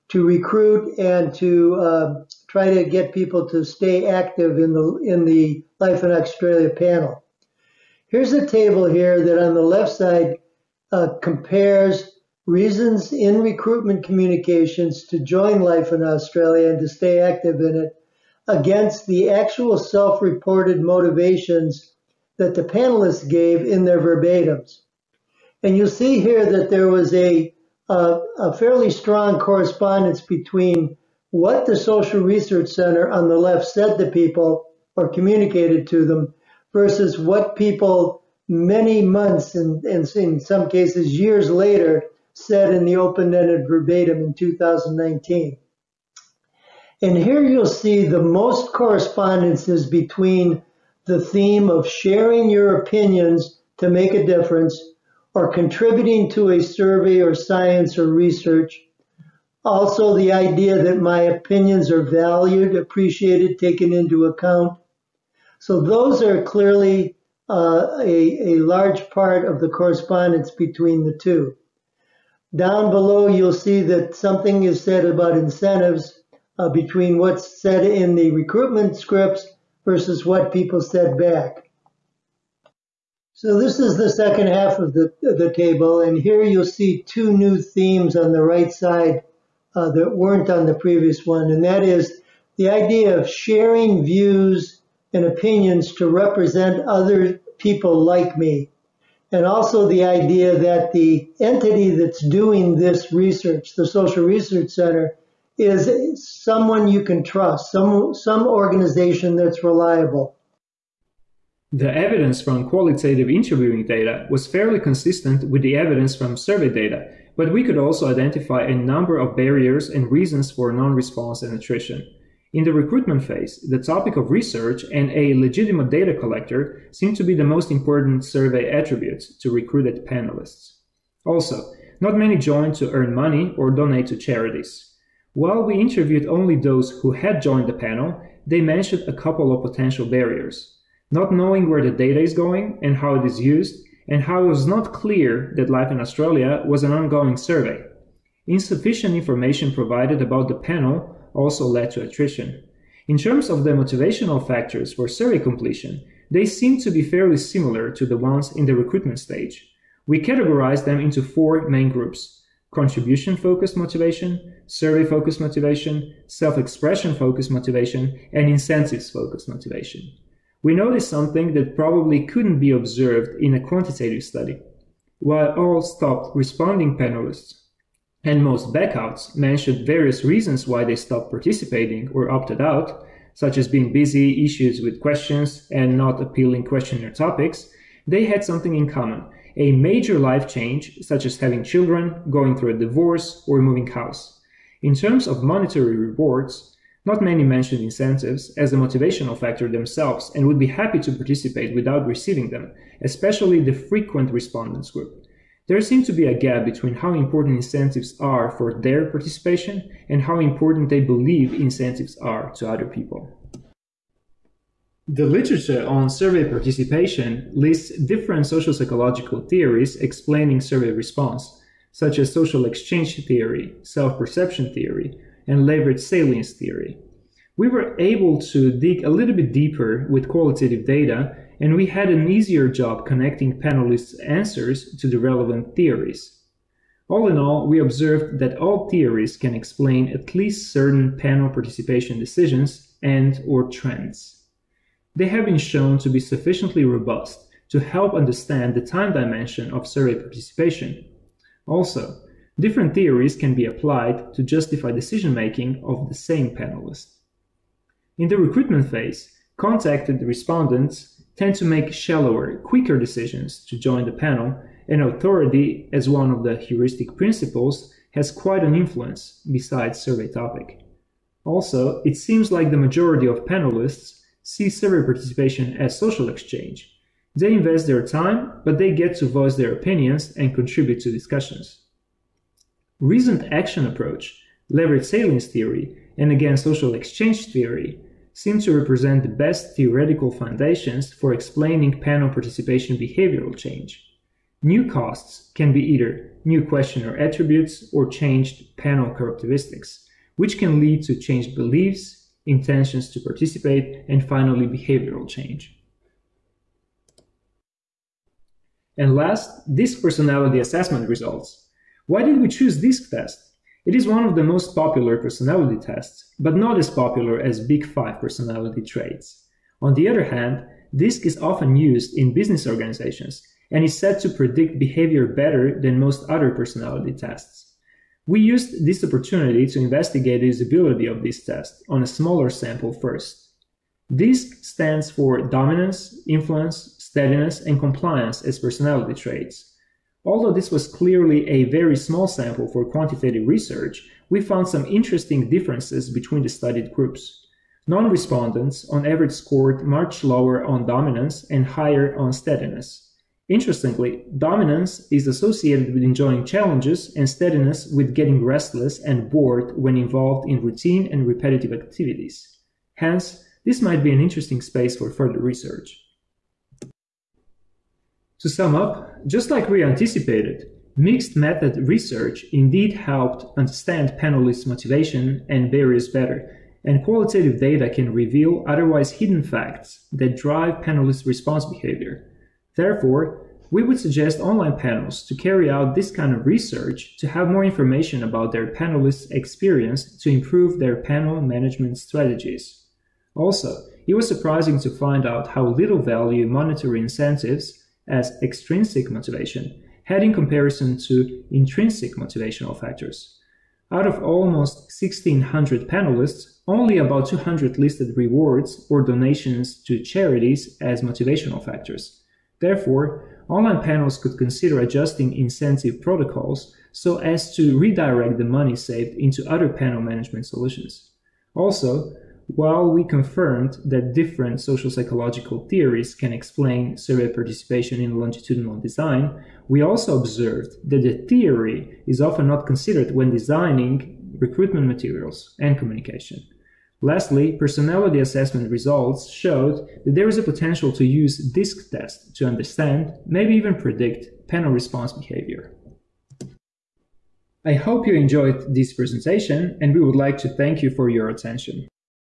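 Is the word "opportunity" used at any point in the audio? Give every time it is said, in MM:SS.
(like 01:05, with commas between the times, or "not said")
05:29.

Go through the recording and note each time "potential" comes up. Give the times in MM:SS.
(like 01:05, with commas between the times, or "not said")
02:19, 07:20.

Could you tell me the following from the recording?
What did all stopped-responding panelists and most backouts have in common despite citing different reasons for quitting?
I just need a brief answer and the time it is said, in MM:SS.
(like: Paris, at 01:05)
A major life change, at 03:09.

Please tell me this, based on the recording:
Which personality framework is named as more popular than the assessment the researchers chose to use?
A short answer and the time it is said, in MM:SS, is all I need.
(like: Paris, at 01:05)
Big Five, at 05:17.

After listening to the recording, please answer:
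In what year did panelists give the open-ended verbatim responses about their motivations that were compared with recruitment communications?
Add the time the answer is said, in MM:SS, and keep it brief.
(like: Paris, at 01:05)
2019, at 00:44.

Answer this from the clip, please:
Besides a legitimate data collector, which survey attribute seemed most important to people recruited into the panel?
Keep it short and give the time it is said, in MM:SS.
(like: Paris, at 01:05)
Topic of research, at 02:03.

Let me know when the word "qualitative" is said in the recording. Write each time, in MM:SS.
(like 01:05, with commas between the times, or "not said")
01:52, 03:50, 06:17.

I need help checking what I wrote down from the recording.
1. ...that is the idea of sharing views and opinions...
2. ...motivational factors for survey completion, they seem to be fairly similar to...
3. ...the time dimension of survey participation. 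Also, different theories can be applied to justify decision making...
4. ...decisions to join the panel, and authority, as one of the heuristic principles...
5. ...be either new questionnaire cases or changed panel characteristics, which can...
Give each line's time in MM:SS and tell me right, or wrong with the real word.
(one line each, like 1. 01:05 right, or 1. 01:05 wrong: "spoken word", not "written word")
1. 01:31 right
2. 02:33 right
3. 04:08 right
4. 04:22 right
5. 04:55 wrong: "attributes", not "cases".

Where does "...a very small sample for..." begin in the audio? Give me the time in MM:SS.
05:41.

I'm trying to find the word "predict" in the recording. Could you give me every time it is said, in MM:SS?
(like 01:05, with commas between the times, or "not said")
05:24, 07:23.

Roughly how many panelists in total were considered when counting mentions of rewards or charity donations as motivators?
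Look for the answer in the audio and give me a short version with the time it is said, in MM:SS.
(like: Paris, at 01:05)
1,600, at 06:45.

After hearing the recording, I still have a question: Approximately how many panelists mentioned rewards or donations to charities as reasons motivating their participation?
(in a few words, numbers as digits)
200.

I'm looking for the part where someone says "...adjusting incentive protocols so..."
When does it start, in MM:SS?
06:54.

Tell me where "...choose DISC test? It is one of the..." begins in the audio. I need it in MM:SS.
05:12.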